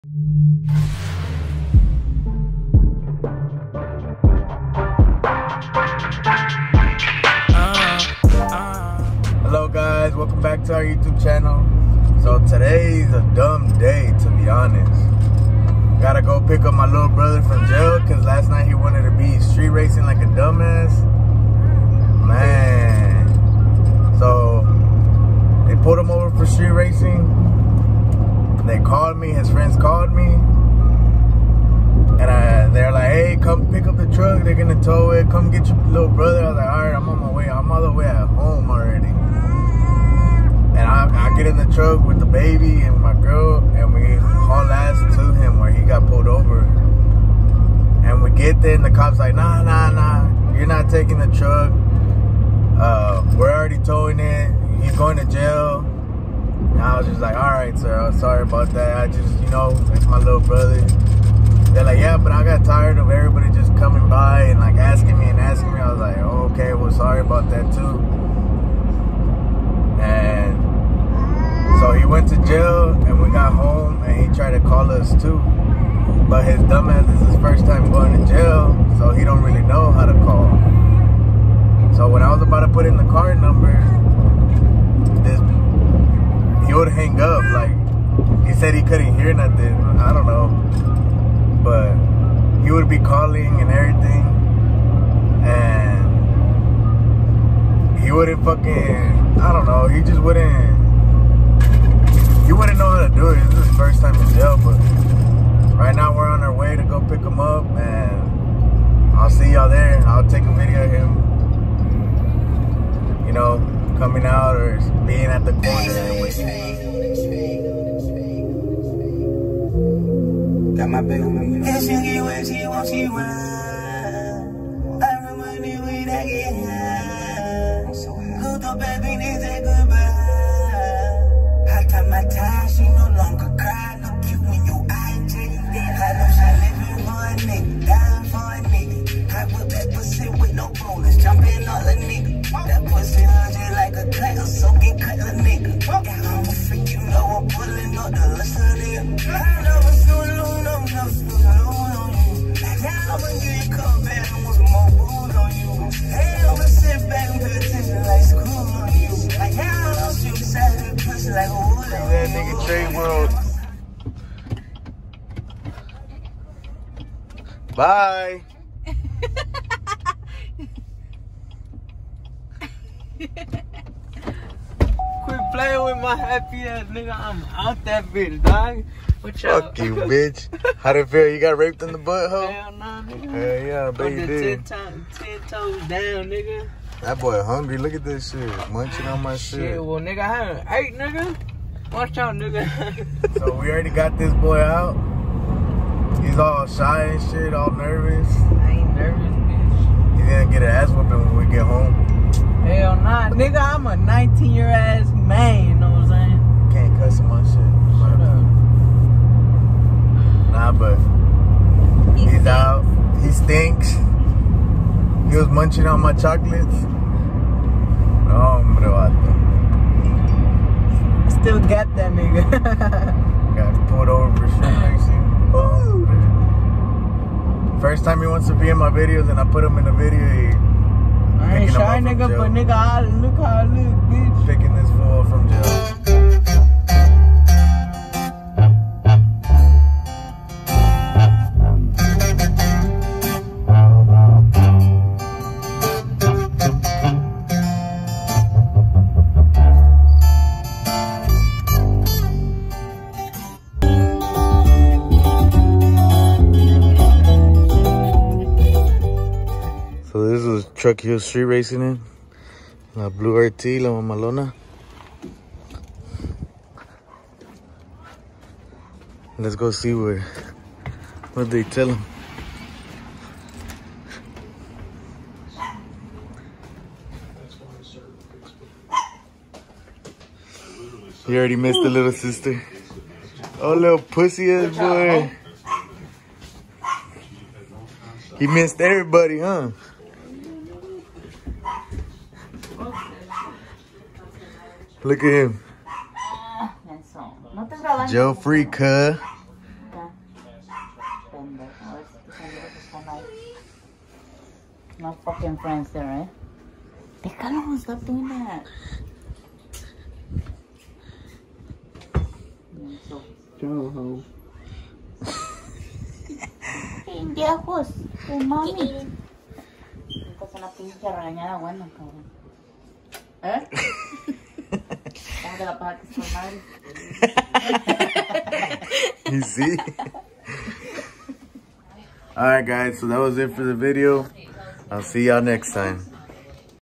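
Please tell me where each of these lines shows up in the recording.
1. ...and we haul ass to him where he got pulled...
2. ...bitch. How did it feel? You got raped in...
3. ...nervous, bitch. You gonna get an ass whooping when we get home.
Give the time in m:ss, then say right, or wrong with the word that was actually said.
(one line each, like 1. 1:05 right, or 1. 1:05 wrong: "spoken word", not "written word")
1. 0:43 right
2. 2:59 right
3. 3:18 right.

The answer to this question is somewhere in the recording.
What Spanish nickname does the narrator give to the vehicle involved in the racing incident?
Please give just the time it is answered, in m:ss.
4:23.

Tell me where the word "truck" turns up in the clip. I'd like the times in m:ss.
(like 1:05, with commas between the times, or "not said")
0:34, 0:41, 0:51, 4:20.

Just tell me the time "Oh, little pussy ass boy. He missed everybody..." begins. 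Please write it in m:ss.
4:43.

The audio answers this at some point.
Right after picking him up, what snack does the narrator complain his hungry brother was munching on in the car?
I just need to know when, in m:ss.
3:36.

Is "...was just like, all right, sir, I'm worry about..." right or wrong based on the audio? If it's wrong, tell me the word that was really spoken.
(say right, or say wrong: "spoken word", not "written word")
wrong: "sorry", not "worry".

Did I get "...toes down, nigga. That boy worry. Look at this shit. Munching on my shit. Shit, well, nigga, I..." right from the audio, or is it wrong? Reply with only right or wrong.
wrong.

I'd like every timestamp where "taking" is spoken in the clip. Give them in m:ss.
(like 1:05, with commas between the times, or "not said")
0:50.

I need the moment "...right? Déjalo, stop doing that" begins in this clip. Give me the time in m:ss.
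5:06.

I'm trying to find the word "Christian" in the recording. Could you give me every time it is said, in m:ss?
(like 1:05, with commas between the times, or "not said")
not said.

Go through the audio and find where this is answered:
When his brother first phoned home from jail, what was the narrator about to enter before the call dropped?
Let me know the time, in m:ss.
1:23.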